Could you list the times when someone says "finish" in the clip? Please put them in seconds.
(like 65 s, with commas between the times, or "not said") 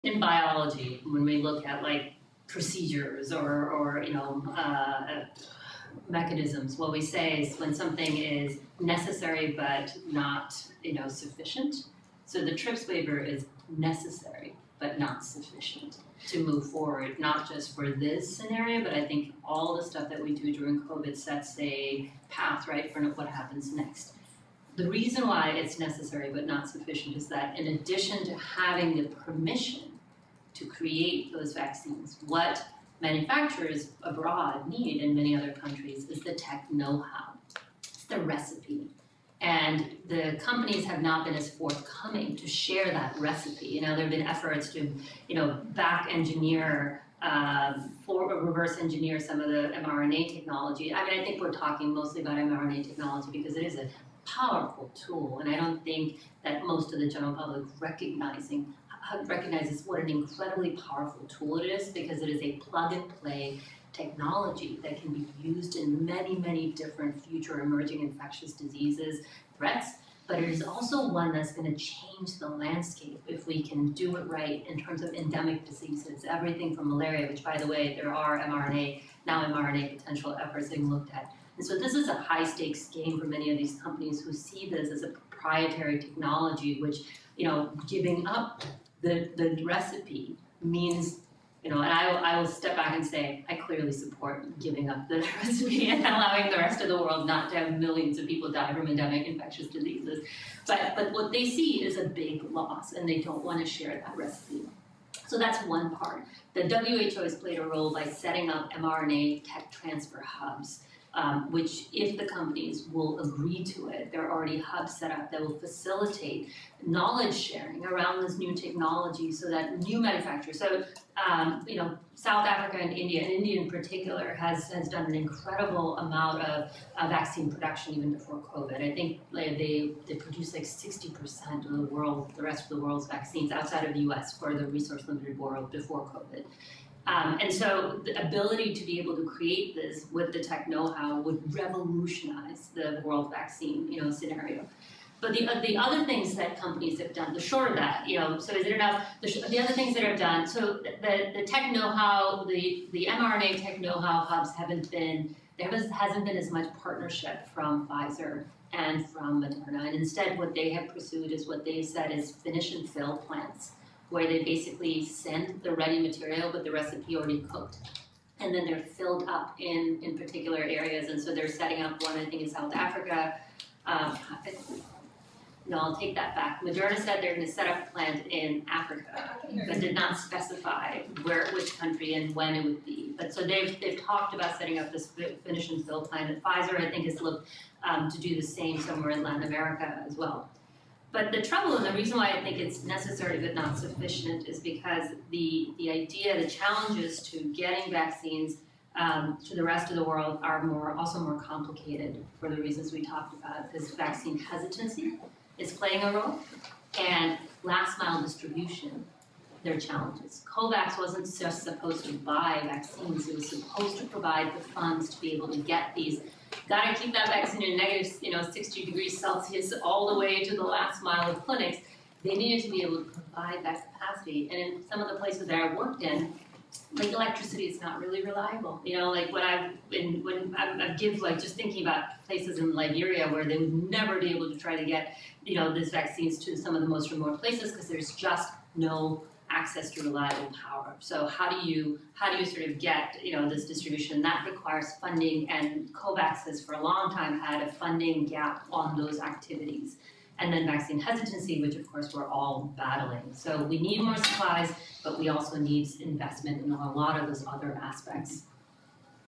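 162 s, 185 s.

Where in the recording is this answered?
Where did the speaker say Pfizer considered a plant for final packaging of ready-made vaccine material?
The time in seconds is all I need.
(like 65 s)
189 s.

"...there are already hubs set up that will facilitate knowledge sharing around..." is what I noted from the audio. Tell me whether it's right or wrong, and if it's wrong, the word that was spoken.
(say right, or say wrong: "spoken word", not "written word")
right.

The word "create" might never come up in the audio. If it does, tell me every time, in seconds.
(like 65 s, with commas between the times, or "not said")
30 s, 139 s.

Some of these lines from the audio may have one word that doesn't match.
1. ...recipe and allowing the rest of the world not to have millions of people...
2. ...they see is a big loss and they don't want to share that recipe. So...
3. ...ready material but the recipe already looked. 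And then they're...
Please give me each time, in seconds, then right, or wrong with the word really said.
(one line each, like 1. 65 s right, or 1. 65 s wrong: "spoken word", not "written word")
1. 95 s right
2. 101 s right
3. 165 s wrong: "cooked", not "looked".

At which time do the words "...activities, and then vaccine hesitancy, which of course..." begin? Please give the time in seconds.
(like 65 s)
249 s.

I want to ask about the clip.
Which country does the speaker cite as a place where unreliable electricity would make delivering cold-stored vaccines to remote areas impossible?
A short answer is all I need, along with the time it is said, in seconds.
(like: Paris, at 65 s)
Liberia, at 232 s.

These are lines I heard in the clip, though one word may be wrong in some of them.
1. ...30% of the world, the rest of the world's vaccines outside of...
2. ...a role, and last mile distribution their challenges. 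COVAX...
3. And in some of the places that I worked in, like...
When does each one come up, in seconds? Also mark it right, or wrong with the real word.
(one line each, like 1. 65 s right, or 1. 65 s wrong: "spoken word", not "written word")
1. 130 s wrong: "60", not "30"
2. 206 s right
3. 224 s right.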